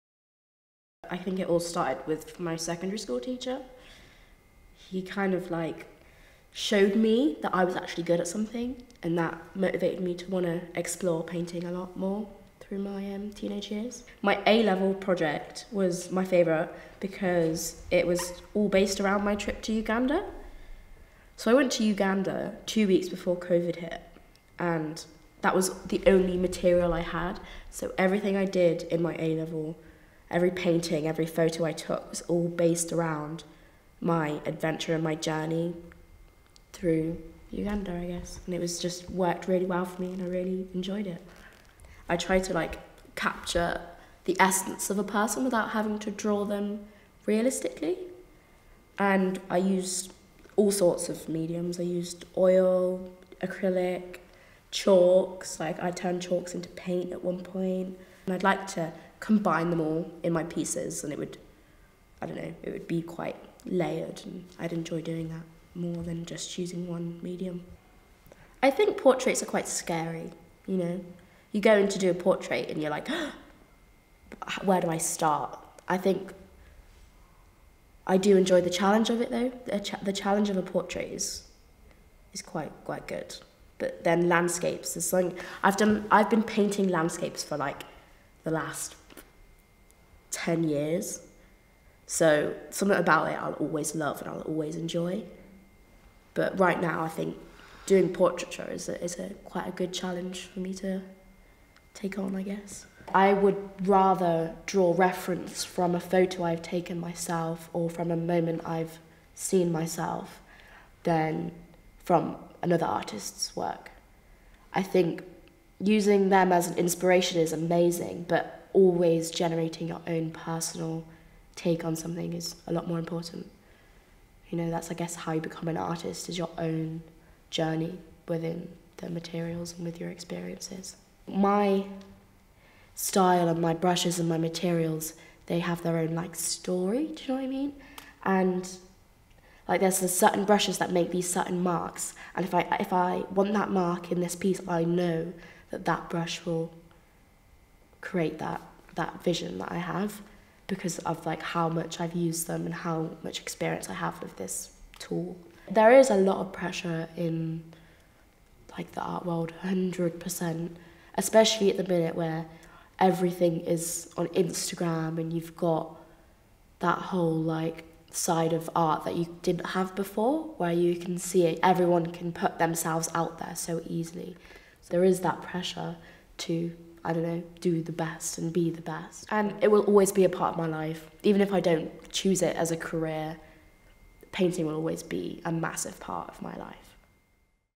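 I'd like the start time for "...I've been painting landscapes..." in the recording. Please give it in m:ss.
1:26.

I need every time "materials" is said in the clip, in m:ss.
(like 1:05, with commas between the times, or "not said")
0:26, 2:09, 2:14.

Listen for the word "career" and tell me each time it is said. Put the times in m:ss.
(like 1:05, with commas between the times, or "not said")
3:02.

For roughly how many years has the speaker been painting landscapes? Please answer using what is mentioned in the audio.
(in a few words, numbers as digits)
10.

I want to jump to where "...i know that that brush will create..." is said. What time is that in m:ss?
2:24.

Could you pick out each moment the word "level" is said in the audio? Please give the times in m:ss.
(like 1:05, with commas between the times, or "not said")
0:14, 0:29.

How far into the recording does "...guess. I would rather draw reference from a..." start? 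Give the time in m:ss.
1:42.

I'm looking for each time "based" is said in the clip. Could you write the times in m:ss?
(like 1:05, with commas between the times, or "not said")
0:18, 0:32.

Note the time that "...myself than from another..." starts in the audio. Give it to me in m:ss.
1:49.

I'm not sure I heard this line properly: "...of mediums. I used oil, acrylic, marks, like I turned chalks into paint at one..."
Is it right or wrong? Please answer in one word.
wrong.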